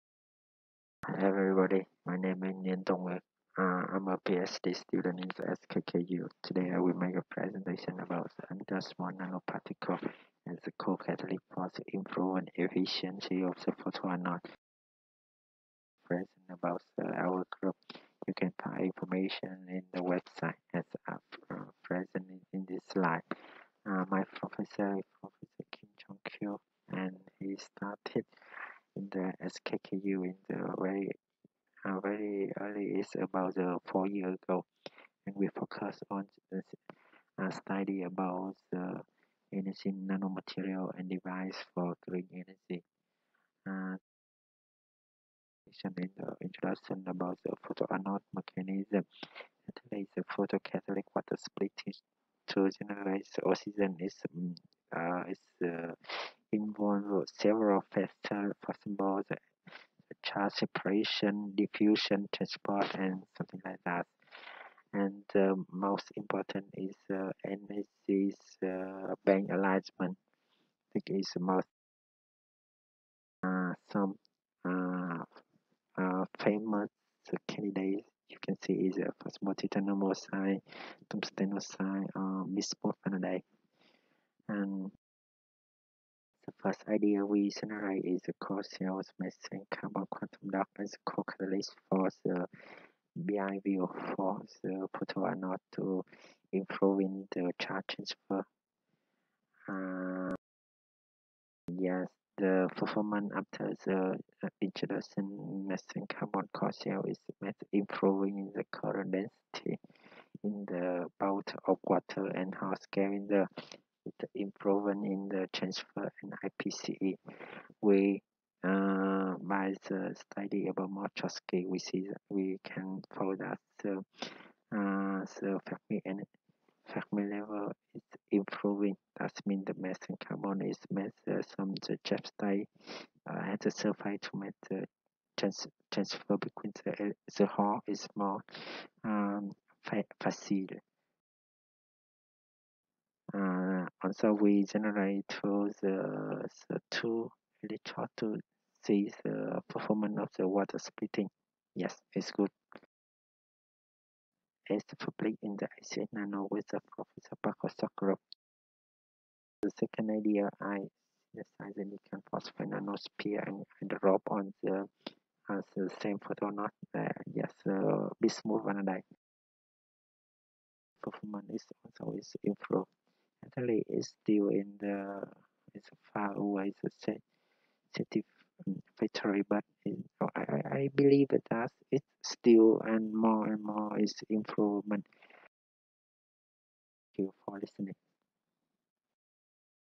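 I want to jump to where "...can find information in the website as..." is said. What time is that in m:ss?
0:18.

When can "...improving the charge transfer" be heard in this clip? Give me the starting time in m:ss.
1:36.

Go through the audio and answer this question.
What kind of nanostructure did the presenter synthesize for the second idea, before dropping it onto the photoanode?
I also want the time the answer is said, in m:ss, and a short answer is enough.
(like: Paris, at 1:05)
Silicon phosphate nanosphere, at 2:41.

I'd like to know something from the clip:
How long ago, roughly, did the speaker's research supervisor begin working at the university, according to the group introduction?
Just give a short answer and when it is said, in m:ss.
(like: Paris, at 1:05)
4 years ago, at 0:33.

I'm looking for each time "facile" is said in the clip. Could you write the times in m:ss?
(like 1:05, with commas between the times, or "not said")
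2:20.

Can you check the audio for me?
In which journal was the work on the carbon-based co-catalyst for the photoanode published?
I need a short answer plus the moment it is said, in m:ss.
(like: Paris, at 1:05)
ACS Nano, at 2:35.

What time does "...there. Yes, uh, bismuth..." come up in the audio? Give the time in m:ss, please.
2:46.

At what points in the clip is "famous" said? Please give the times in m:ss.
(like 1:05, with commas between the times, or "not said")
1:16.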